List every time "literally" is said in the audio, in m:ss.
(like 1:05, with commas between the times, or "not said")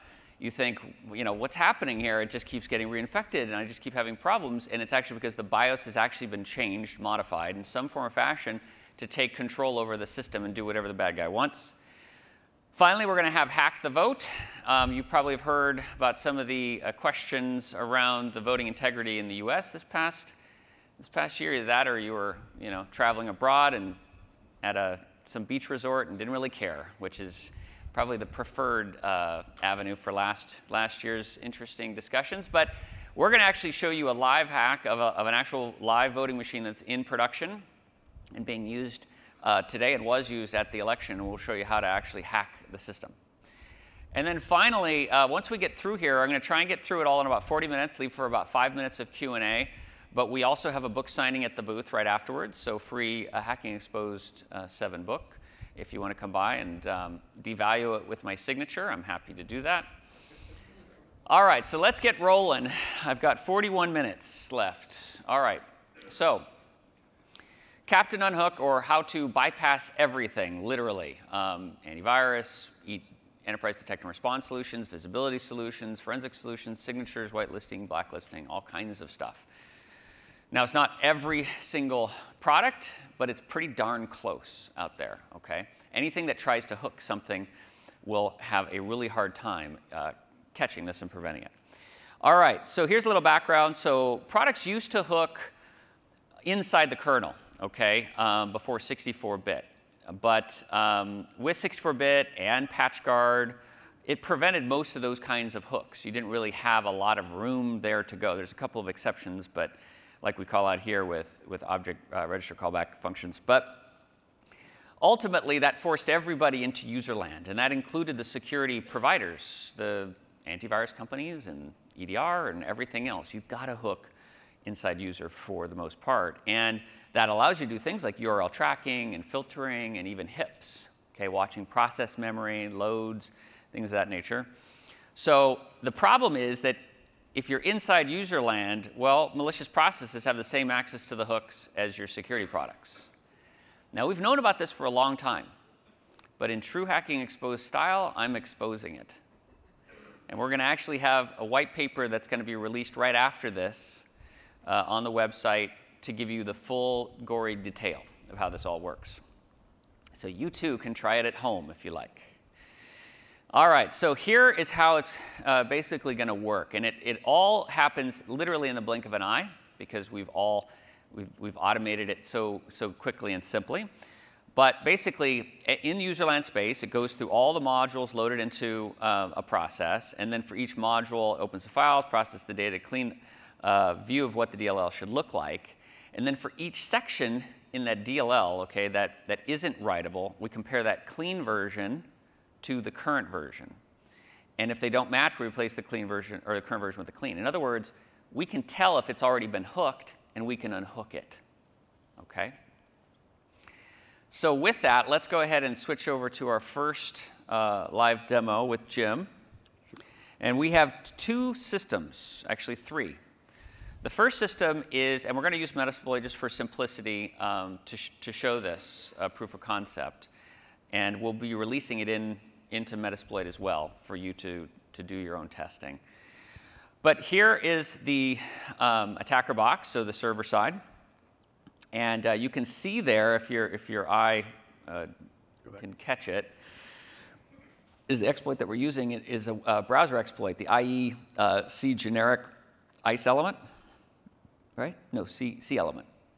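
1:10, 2:48.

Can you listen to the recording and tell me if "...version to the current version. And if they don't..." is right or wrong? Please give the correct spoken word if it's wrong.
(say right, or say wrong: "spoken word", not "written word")
right.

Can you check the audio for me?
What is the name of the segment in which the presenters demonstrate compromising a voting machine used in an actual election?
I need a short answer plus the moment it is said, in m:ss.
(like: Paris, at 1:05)
Hack the Vote, at 0:13.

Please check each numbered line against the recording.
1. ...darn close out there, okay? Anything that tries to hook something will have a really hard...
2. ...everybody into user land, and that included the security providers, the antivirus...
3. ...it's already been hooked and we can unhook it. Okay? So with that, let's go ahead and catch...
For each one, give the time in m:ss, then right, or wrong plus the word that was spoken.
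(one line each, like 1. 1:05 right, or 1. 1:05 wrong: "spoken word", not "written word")
1. 1:23 right
2. 1:56 right
3. 3:19 wrong: "switch", not "catch".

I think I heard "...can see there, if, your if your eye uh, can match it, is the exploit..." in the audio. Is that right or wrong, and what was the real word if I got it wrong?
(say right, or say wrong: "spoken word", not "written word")
wrong: "catch", not "match".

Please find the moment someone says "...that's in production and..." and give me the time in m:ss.
0:36.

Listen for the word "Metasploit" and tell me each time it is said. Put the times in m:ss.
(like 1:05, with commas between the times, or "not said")
3:35, 3:42.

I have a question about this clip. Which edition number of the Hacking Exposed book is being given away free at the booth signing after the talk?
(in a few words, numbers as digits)
7.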